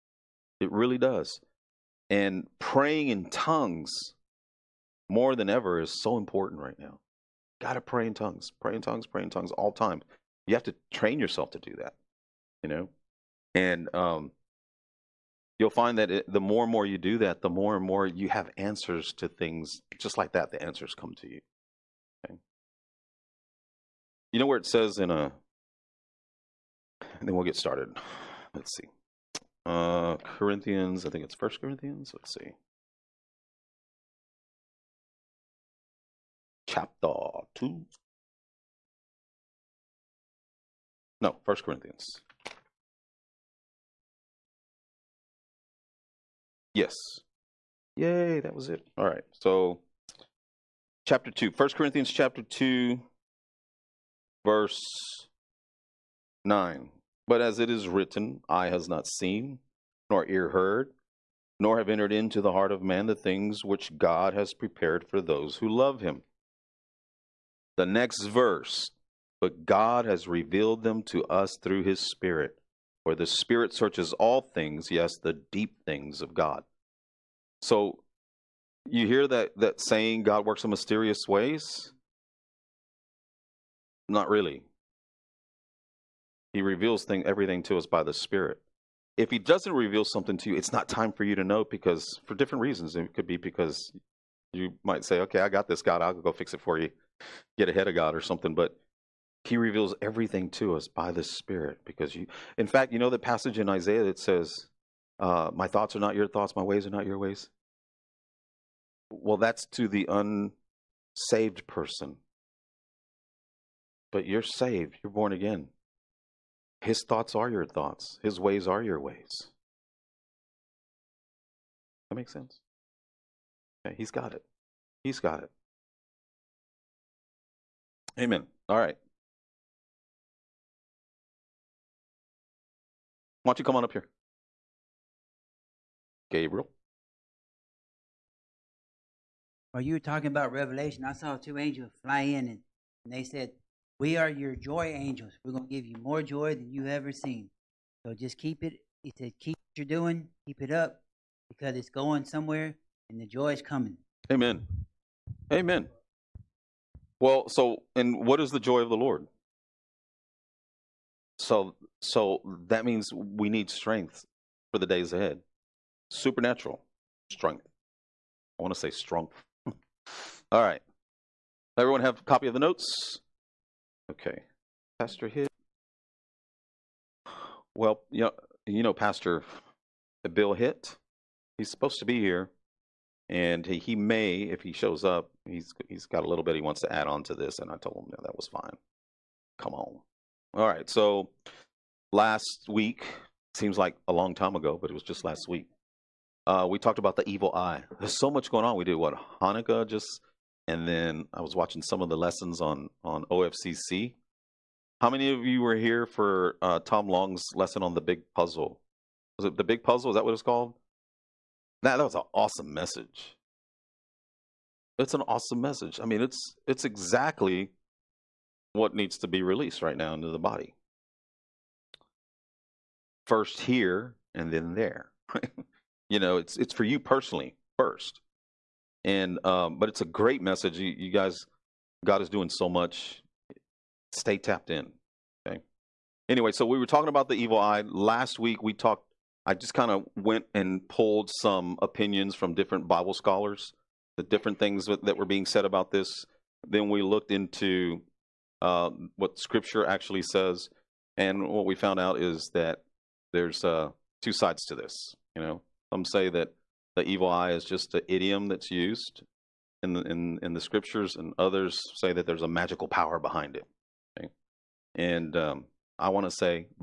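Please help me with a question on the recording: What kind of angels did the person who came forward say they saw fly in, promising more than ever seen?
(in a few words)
Joy angels.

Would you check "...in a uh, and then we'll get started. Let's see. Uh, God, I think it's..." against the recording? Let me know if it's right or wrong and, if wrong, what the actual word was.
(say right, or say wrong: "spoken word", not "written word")
wrong: "Corinthians", not "God".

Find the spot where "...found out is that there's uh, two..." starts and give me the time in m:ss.
4:11.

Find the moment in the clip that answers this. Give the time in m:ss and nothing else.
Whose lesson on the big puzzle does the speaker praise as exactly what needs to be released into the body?
3:26.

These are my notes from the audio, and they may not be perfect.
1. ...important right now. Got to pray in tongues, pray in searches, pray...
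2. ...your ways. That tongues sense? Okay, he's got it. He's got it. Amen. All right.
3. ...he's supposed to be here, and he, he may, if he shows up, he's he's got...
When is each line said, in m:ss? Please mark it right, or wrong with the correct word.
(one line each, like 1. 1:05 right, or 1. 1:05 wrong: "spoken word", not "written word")
1. 0:06 wrong: "tongues", not "searches"
2. 1:58 wrong: "makes", not "tongues"
3. 3:01 right.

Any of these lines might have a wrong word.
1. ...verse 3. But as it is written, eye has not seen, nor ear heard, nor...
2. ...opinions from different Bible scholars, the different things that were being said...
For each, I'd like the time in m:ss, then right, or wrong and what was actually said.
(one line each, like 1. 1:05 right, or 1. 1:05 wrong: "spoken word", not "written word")
1. 0:54 wrong: "9", not "3"
2. 4:01 right.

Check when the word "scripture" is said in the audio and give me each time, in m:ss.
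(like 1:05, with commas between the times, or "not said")
4:09, 4:20.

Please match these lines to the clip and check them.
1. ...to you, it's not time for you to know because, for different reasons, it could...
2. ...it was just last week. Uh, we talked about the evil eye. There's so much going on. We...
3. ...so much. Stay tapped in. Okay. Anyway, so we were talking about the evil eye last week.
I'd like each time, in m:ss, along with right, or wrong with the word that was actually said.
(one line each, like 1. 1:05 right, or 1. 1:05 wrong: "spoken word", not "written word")
1. 1:30 right
2. 3:14 right
3. 3:52 right.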